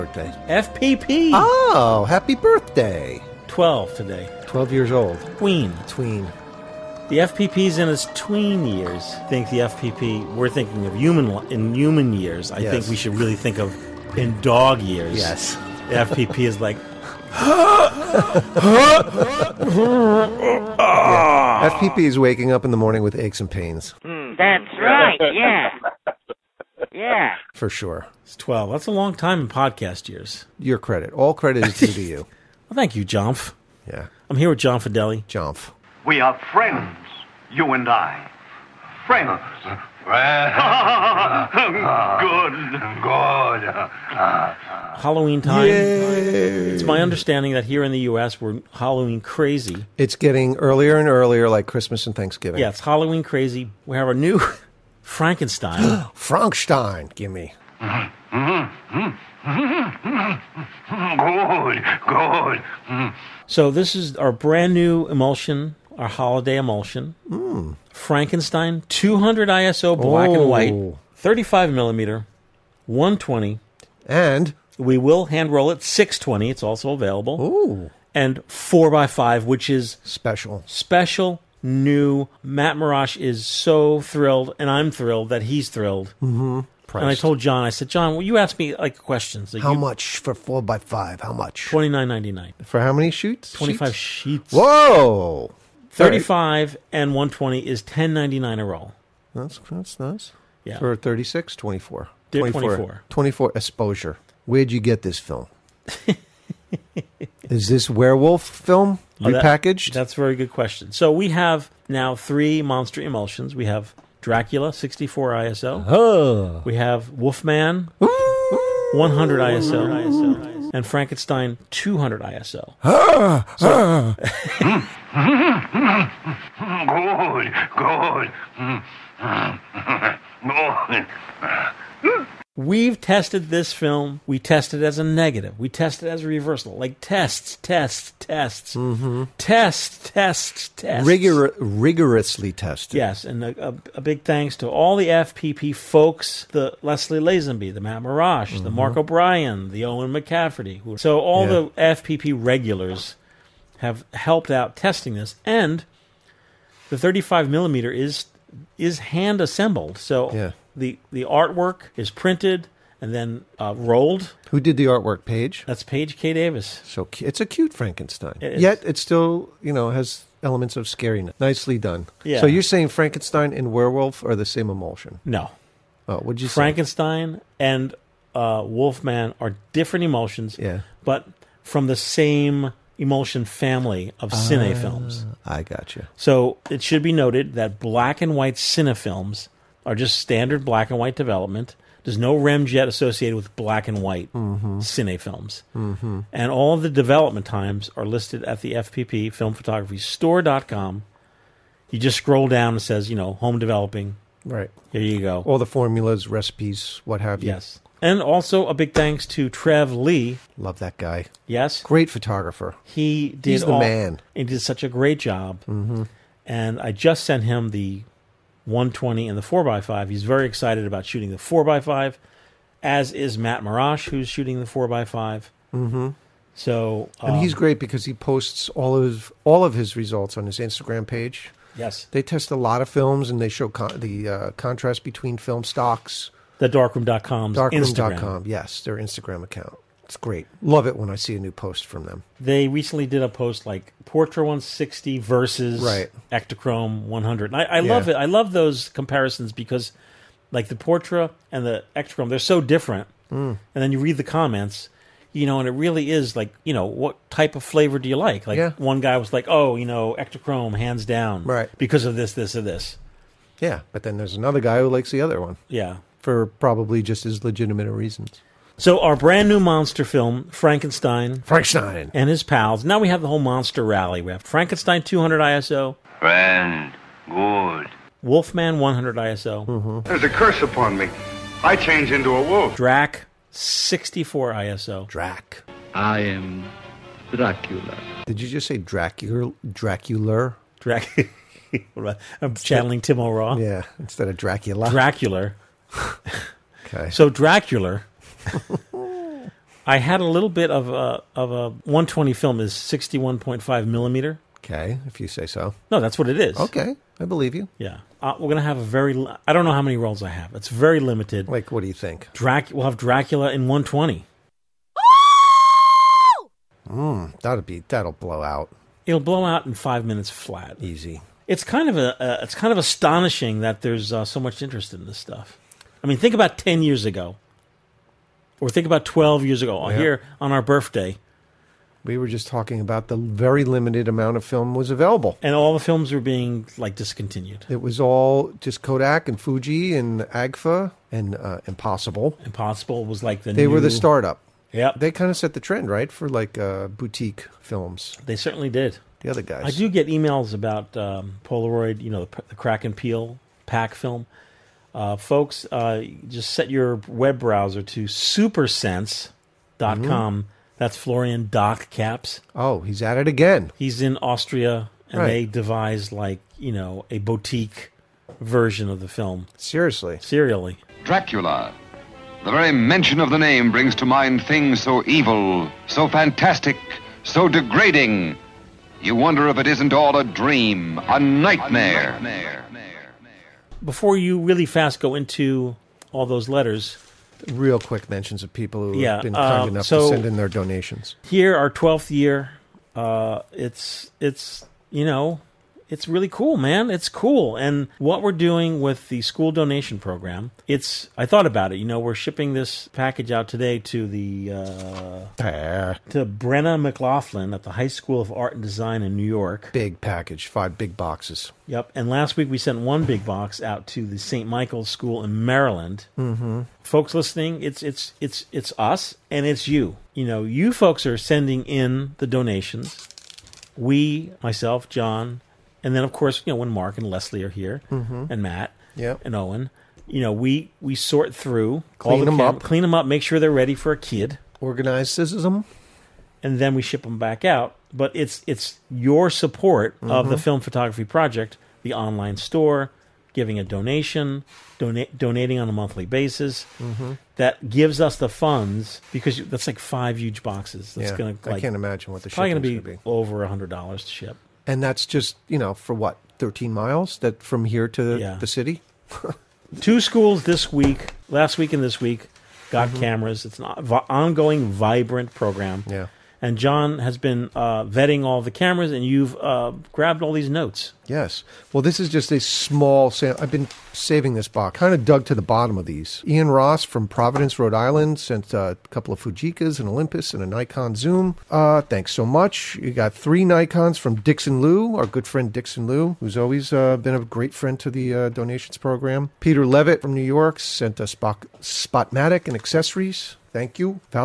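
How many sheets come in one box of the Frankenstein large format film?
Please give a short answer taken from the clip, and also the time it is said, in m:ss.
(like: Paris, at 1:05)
25, at 1:33.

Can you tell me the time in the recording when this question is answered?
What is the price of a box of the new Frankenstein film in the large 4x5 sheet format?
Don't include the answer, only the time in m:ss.
1:31.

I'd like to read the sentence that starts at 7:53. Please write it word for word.
I've been saving this box, kind of dug to the bottom of these.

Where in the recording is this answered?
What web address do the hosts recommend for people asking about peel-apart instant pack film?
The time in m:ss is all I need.
5:58.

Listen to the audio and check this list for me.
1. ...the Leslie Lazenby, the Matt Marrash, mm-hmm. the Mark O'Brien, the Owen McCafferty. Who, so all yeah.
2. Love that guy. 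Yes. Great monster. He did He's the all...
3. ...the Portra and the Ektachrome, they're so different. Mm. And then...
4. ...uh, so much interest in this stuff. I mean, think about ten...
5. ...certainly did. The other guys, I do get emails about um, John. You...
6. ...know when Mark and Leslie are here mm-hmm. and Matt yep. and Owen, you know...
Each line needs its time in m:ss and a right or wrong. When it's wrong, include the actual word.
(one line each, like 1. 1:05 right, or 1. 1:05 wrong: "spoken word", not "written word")
1. 2:26 right
2. 3:30 wrong: "photographer", not "monster"
3. 4:10 right
4. 5:24 right
5. 5:48 wrong: "Polaroid", not "John"
6. 7:06 right.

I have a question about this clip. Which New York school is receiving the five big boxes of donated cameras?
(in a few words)
High School of Art and Design.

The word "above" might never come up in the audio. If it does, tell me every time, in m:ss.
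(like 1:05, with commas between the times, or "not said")
not said.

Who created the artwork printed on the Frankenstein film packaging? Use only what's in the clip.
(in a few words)
Page K. Davis.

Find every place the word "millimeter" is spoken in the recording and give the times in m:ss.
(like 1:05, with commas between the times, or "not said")
1:11, 2:37, 5:03.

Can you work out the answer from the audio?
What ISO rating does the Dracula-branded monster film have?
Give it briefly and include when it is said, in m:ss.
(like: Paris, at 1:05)
64, at 1:54.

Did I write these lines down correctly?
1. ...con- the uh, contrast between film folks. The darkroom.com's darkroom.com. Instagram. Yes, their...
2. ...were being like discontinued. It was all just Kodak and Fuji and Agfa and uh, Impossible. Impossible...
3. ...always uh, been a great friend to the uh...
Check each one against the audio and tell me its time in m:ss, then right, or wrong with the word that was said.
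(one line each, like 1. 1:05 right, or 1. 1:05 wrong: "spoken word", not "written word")
1. 3:53 wrong: "stocks", not "folks"
2. 5:36 right
3. 8:06 right.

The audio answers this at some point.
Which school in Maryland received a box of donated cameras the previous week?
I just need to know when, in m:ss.
6:54.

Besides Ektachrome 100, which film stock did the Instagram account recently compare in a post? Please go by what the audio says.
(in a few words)
Portra 160.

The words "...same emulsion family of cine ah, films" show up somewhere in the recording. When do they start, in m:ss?
3:01.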